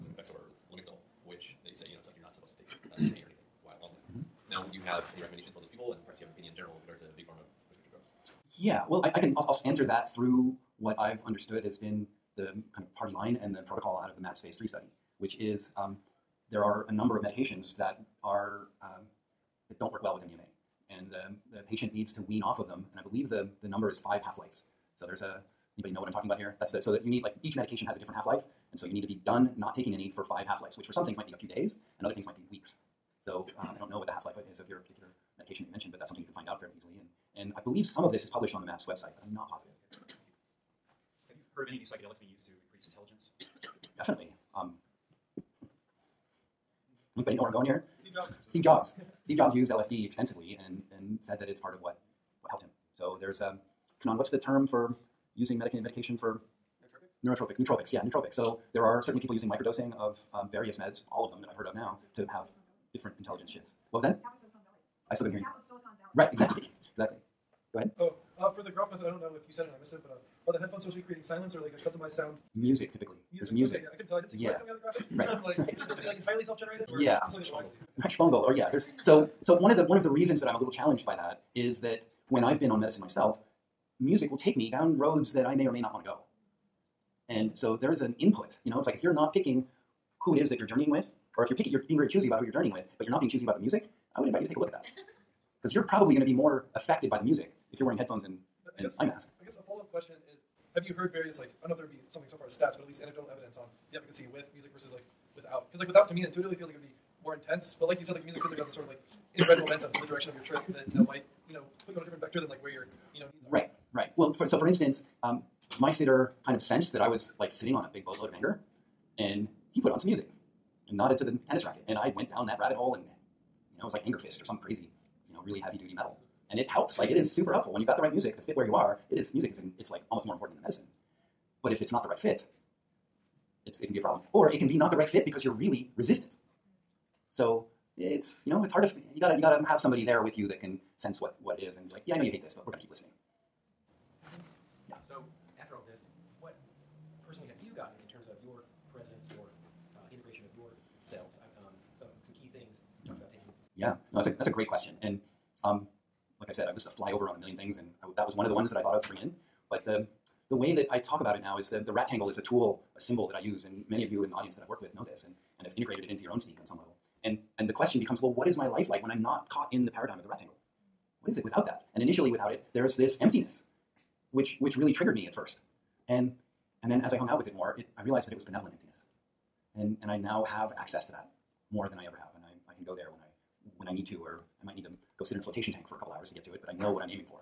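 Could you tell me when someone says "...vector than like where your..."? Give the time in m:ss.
1:52.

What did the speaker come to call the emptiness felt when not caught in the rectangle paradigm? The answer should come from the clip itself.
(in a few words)
Benevolent emptiness.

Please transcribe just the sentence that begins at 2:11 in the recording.
But if it's not the right fit, it's it can be a problem.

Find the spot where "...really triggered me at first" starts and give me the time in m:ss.
2:54.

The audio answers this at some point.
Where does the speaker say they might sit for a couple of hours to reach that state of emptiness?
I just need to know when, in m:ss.
3:05.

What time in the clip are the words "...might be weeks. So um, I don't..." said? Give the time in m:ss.
0:32.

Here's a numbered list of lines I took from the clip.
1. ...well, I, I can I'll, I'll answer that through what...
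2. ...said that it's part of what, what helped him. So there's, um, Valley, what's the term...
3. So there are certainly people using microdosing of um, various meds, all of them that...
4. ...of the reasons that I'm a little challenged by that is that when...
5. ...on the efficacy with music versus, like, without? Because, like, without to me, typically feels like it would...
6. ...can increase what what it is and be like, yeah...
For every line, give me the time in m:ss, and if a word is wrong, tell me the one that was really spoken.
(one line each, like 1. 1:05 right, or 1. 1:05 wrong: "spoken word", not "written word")
1. 0:08 right
2. 0:51 wrong: "Kanan", not "Valley"
3. 0:58 right
4. 1:19 right
5. 1:43 wrong: "intuitively", not "typically"
6. 2:20 wrong: "sense", not "increase".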